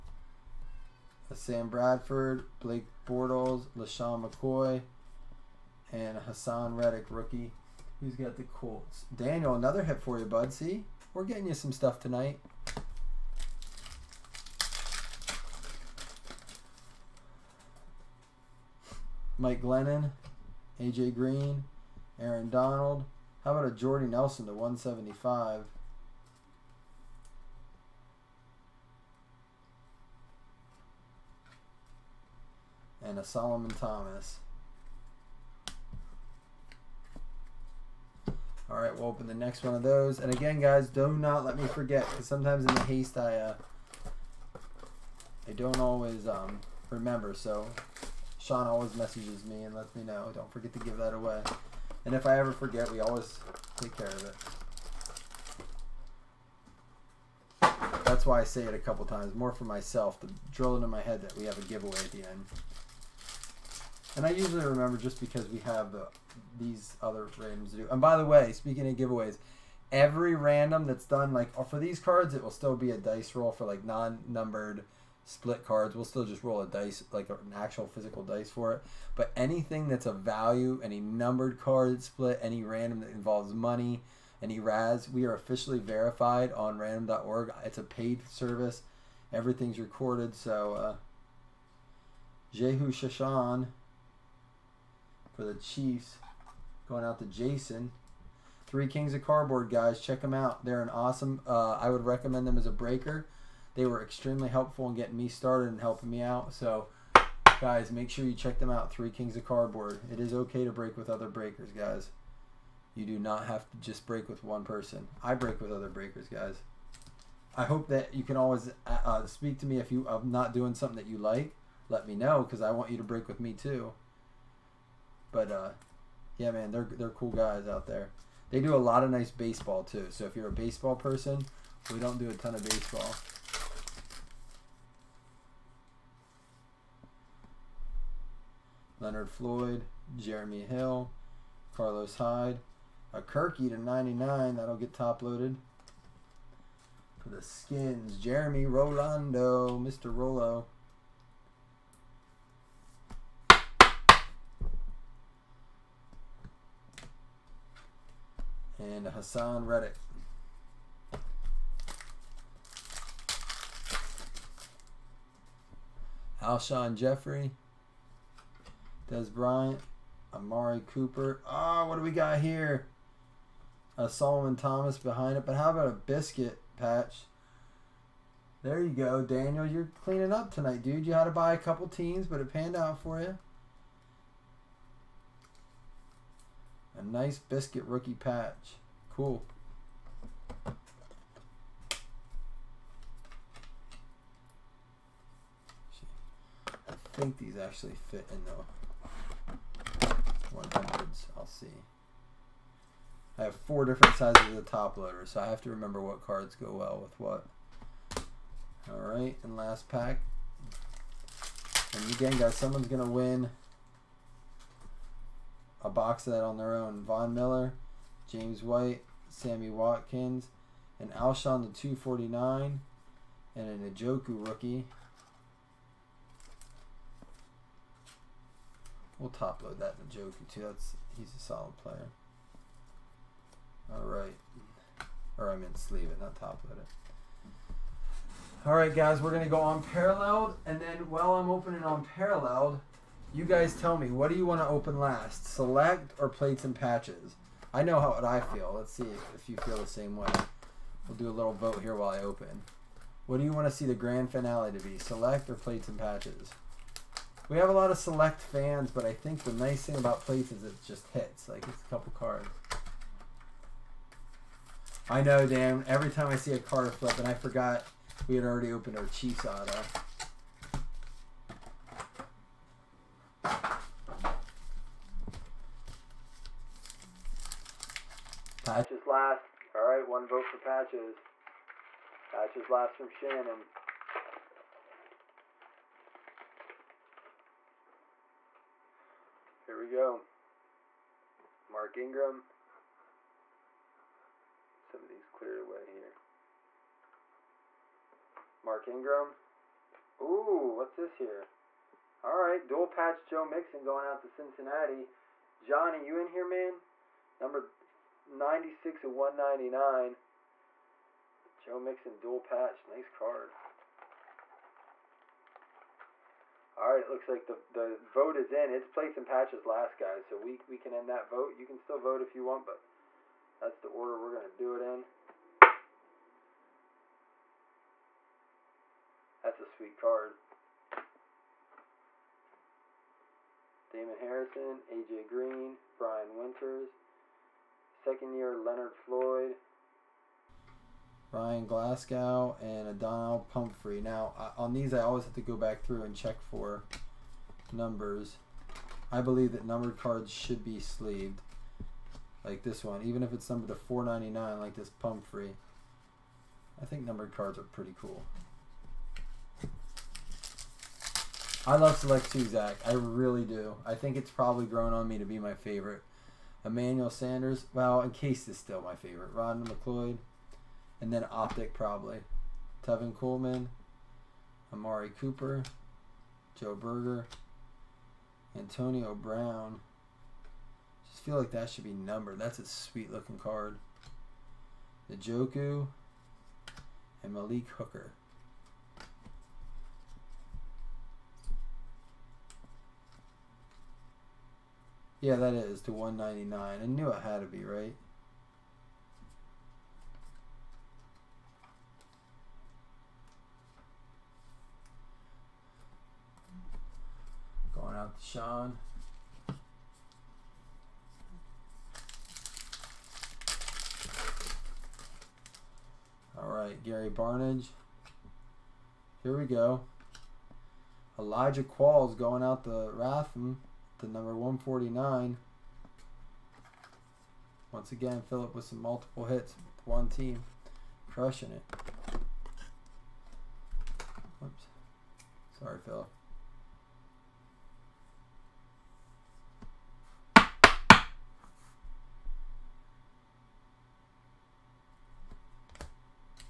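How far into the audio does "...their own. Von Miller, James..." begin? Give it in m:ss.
3:36.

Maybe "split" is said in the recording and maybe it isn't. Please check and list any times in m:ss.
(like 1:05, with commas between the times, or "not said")
1:15, 1:22.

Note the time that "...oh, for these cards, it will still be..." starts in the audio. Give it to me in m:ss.
1:11.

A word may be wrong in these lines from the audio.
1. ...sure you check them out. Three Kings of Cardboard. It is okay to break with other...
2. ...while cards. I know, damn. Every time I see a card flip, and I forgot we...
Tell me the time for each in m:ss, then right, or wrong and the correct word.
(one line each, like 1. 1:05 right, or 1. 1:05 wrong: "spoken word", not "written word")
1. 1:48 right
2. 4:21 wrong: "couple", not "while".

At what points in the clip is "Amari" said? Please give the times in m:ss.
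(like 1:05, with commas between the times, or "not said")
2:50, 6:14.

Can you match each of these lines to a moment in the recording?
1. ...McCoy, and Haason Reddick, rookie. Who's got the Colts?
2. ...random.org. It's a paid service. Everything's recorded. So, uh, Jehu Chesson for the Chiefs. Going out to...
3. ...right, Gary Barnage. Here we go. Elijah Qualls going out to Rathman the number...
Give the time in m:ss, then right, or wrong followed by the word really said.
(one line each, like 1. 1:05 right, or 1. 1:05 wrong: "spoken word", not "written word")
1. 0:04 right
2. 1:26 right
3. 6:56 right.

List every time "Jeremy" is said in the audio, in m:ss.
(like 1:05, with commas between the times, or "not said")
2:20, 2:28.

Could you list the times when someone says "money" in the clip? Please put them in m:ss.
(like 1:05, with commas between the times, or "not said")
1:23.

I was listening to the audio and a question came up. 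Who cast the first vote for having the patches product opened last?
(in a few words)
Shannon.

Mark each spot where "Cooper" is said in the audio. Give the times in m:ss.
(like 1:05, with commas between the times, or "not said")
2:50, 6:15.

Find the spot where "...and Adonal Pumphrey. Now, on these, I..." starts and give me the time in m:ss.
5:42.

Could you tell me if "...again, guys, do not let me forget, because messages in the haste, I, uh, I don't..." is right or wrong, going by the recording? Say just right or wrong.
wrong.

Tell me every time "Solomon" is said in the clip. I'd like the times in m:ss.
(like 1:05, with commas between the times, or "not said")
0:33, 2:54.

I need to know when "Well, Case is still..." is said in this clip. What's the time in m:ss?
6:07.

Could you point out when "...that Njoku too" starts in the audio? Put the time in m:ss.
3:49.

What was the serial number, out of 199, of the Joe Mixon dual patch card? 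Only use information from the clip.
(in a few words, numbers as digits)
96.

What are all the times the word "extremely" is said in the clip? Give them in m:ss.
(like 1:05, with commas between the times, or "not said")
1:44.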